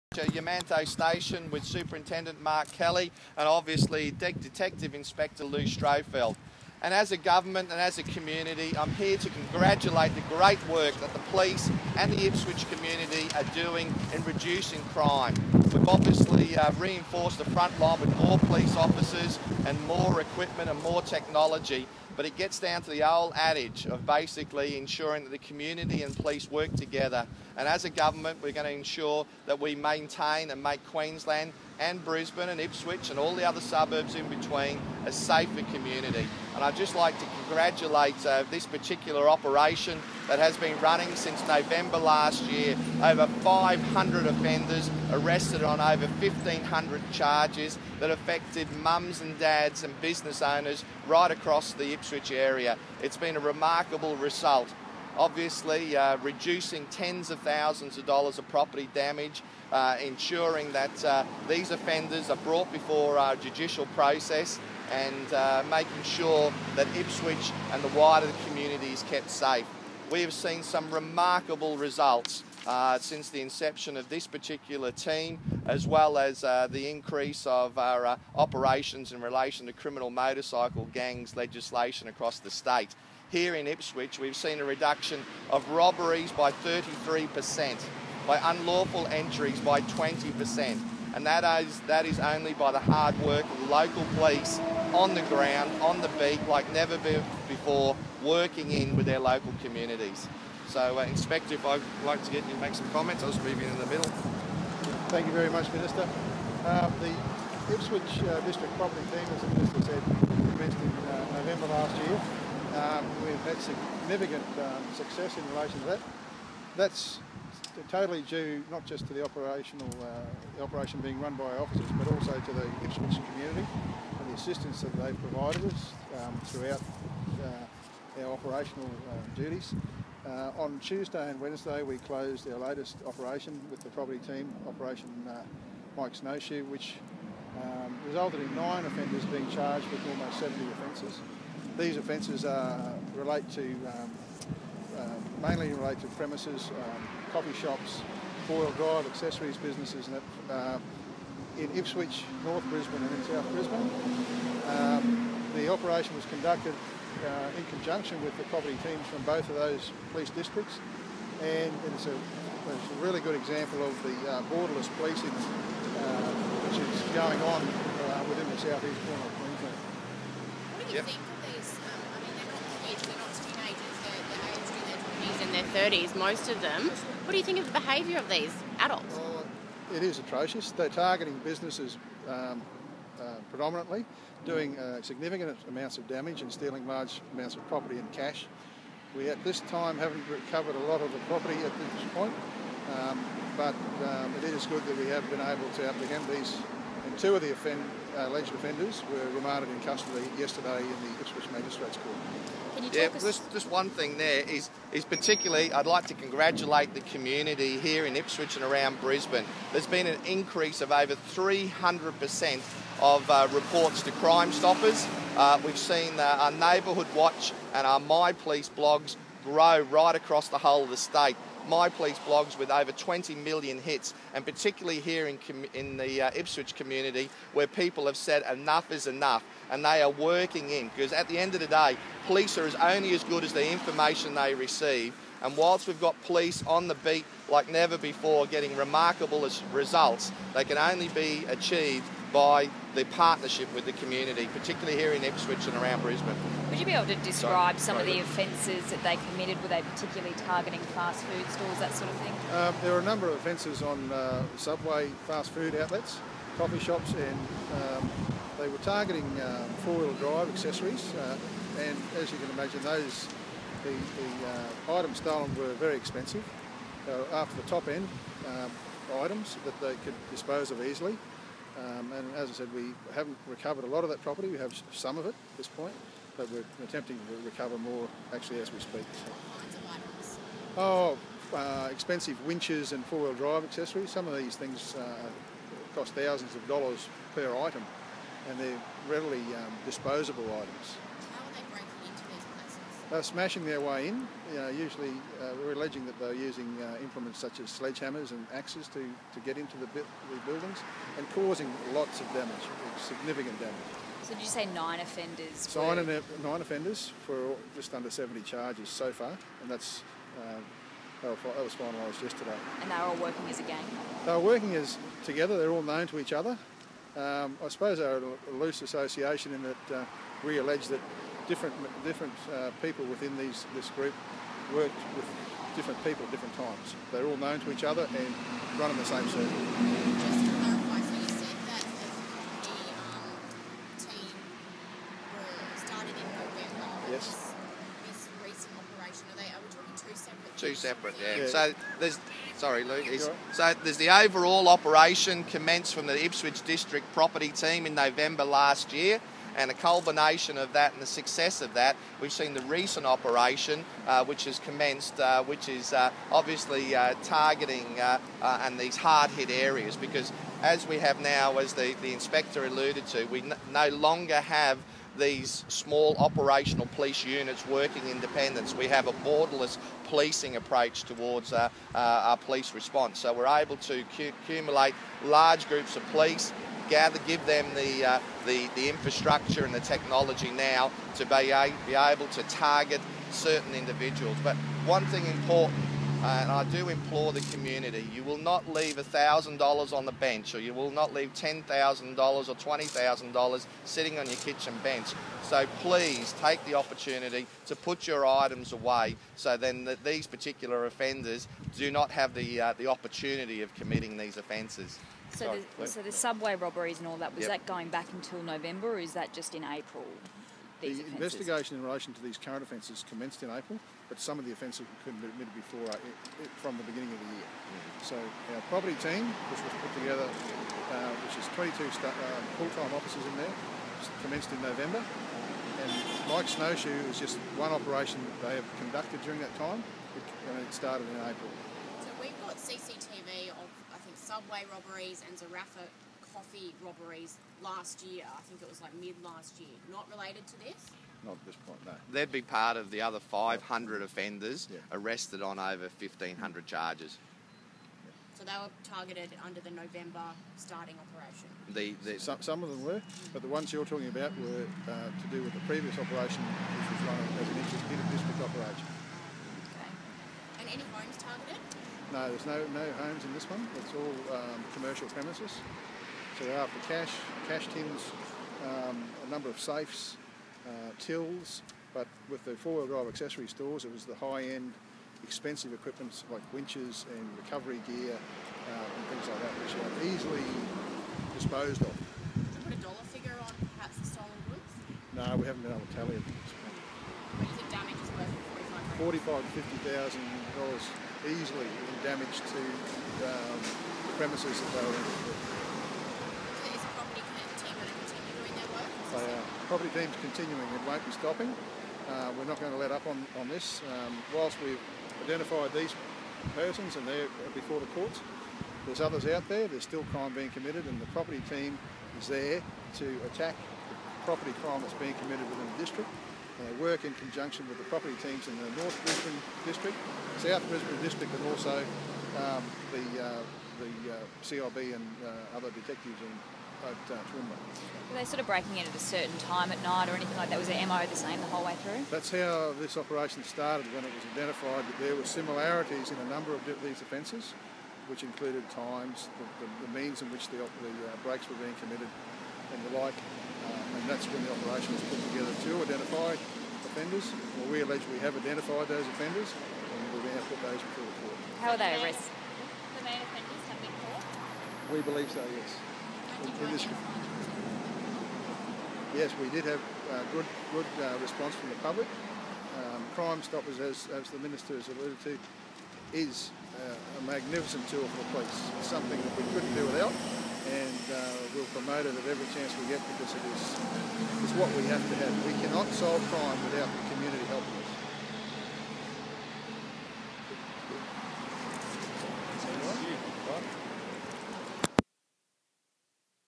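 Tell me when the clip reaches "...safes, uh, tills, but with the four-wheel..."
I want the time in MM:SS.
07:49.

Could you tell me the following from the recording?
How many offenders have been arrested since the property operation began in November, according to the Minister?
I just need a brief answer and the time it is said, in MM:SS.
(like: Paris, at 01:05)
500, at 00:43.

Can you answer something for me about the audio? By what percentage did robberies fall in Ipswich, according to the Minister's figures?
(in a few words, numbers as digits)
33%.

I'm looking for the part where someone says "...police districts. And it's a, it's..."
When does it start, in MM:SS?
02:40.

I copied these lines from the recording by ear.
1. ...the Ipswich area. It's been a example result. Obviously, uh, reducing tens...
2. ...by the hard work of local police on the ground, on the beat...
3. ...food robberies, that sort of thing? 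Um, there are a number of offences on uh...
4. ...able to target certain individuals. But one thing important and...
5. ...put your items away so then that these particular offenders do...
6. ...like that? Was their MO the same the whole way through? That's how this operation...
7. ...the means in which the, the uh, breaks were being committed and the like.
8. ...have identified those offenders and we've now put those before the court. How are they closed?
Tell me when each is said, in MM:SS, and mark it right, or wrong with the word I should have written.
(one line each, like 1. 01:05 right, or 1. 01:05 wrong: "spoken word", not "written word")
1. 00:51 wrong: "remarkable", not "example"
2. 01:32 right
3. 04:11 wrong: "stores", not "robberies"
4. 06:21 right
5. 06:37 right
6. 08:50 right
7. 08:59 right
8. 09:08 wrong: "arrested", not "closed".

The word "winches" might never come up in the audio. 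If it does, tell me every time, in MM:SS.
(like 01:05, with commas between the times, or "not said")
04:42, 07:56.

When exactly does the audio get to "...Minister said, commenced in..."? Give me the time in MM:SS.
01:49.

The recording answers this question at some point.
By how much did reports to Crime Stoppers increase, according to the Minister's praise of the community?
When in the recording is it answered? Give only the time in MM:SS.
03:30.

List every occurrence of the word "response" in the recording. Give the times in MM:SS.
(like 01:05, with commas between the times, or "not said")
06:12, 09:21.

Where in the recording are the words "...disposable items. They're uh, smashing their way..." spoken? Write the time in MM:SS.
04:49.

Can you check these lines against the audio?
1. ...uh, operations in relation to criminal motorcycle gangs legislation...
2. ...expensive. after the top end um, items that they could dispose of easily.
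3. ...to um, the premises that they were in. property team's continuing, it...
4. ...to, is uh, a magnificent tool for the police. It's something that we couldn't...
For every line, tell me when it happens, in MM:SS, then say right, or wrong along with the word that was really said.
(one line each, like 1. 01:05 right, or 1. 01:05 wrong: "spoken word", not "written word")
1. 01:18 right
2. 04:25 right
3. 08:12 right
4. 09:25 right.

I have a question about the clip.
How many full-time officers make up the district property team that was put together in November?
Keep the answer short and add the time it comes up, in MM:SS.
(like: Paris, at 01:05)
22, at 07:01.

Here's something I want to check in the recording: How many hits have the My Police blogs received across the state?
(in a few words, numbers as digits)
20 million.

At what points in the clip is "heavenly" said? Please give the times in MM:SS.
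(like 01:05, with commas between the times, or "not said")
not said.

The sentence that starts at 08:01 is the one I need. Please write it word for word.
Did you put a dollar figure on perhaps the stolen goods?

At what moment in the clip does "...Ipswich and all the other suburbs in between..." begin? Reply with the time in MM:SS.
00:32.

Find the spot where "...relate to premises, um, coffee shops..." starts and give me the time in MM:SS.
02:25.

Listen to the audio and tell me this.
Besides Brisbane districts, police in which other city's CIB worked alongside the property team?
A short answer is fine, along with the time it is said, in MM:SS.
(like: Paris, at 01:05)
Toowoomba, at 08:47.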